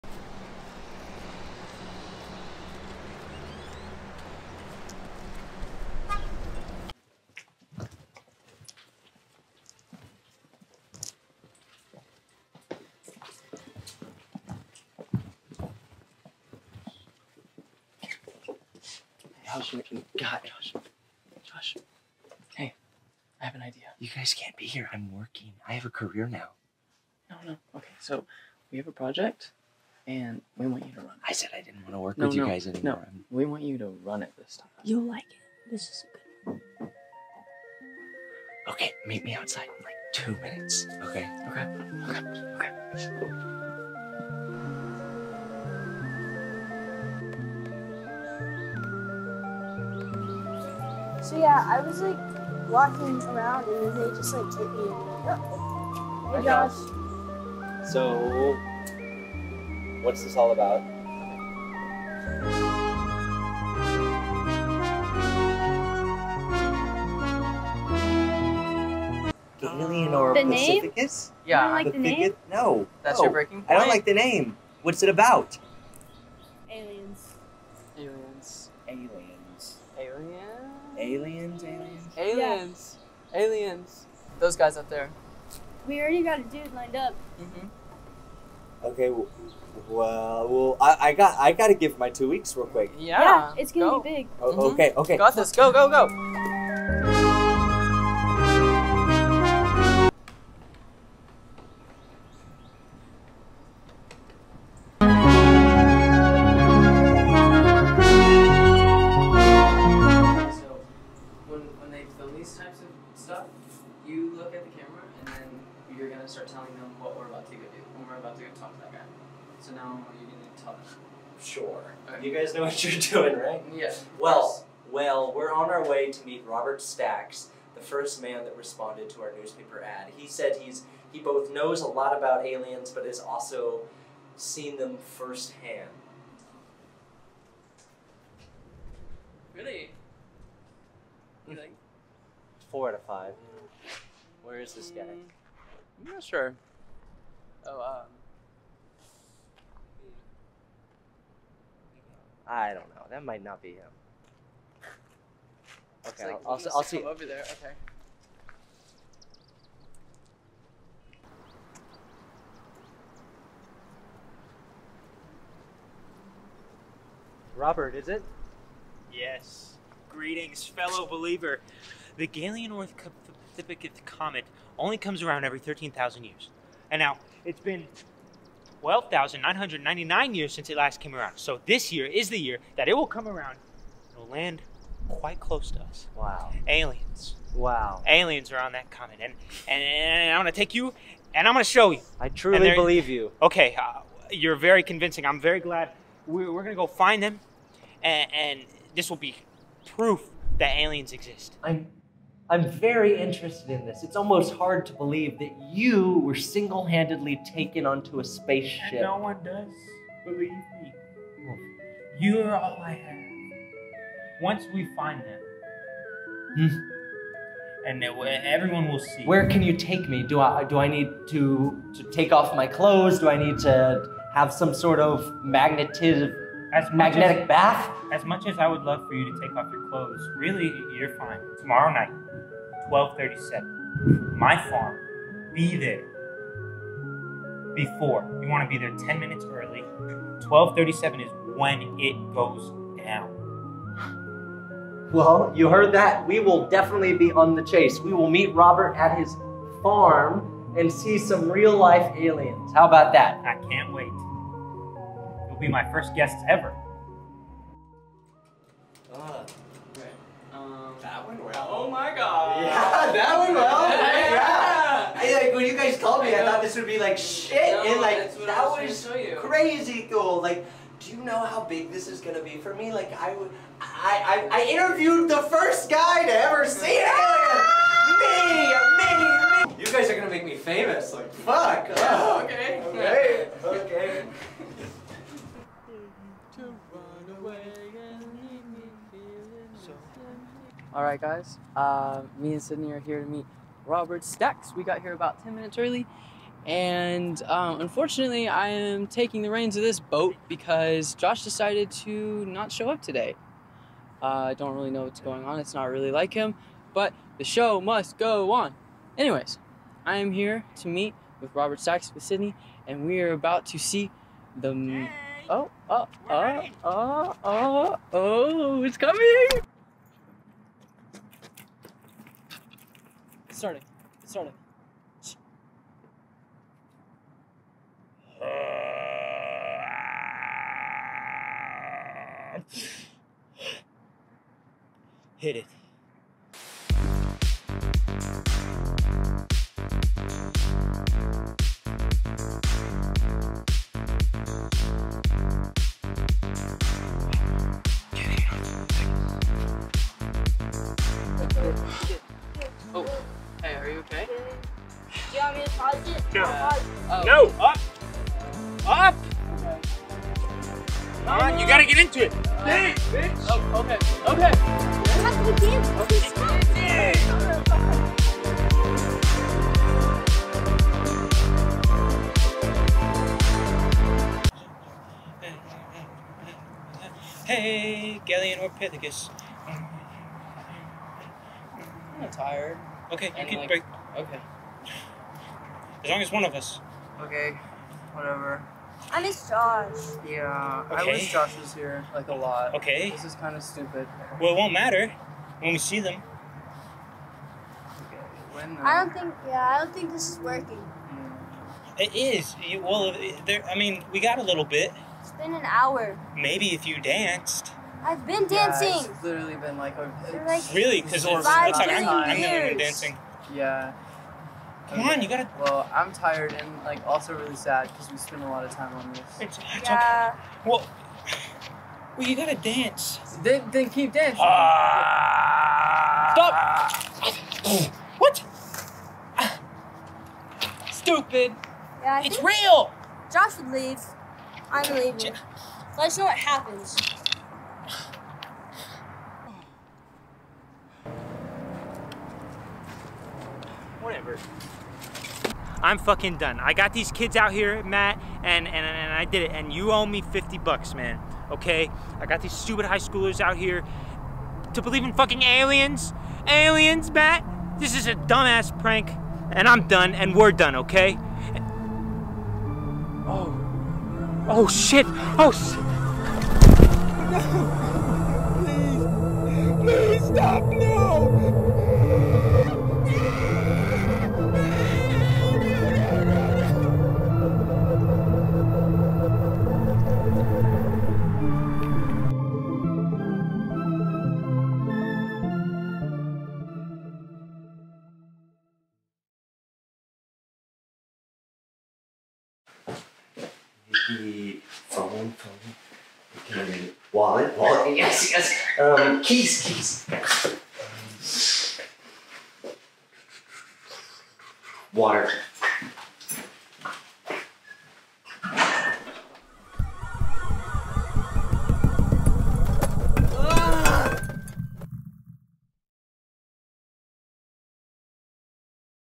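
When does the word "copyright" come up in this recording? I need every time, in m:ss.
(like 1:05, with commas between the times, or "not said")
not said.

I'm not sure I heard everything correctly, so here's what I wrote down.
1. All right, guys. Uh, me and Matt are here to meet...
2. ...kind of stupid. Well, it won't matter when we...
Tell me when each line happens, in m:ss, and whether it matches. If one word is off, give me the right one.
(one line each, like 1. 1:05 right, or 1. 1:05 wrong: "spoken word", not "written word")
1. 4:50 wrong: "Sydney", not "Matt"
2. 6:33 right.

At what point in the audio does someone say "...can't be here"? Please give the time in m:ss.
0:24.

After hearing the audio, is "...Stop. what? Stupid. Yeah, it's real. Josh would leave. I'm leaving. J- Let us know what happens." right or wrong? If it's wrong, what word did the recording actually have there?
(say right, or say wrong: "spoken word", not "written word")
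right.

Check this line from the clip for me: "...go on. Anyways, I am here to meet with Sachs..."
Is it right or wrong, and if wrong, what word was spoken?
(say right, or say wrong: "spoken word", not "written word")
wrong: "Robert", not "Sachs".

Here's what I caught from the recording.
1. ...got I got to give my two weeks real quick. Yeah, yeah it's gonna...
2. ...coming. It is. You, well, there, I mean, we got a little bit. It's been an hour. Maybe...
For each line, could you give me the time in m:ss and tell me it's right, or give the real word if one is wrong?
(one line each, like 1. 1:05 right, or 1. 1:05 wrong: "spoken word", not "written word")
1. 1:31 right
2. 6:40 wrong: "working", not "coming".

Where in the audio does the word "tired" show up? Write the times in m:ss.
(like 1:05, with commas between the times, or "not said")
6:22, 6:56.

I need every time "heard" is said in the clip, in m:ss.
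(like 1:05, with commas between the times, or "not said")
4:05.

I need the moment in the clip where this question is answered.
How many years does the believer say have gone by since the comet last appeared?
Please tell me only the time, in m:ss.
2:58.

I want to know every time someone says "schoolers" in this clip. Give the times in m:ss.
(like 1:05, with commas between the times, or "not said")
7:32.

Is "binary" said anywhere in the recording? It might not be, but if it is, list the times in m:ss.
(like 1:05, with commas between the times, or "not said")
not said.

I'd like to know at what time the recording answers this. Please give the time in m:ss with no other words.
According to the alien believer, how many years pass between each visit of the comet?
2:55.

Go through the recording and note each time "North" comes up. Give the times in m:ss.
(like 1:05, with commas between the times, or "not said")
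2:52.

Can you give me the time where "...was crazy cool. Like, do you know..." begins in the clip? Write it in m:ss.
4:29.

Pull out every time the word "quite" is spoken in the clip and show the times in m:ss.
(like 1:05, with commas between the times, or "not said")
3:05.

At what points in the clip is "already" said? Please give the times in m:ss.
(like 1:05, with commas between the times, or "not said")
1:25.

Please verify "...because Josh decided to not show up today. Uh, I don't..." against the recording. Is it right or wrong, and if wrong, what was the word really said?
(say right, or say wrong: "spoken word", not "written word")
right.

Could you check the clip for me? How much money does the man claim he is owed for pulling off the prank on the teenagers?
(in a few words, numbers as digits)
50 bucks.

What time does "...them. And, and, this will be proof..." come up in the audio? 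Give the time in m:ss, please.
3:17.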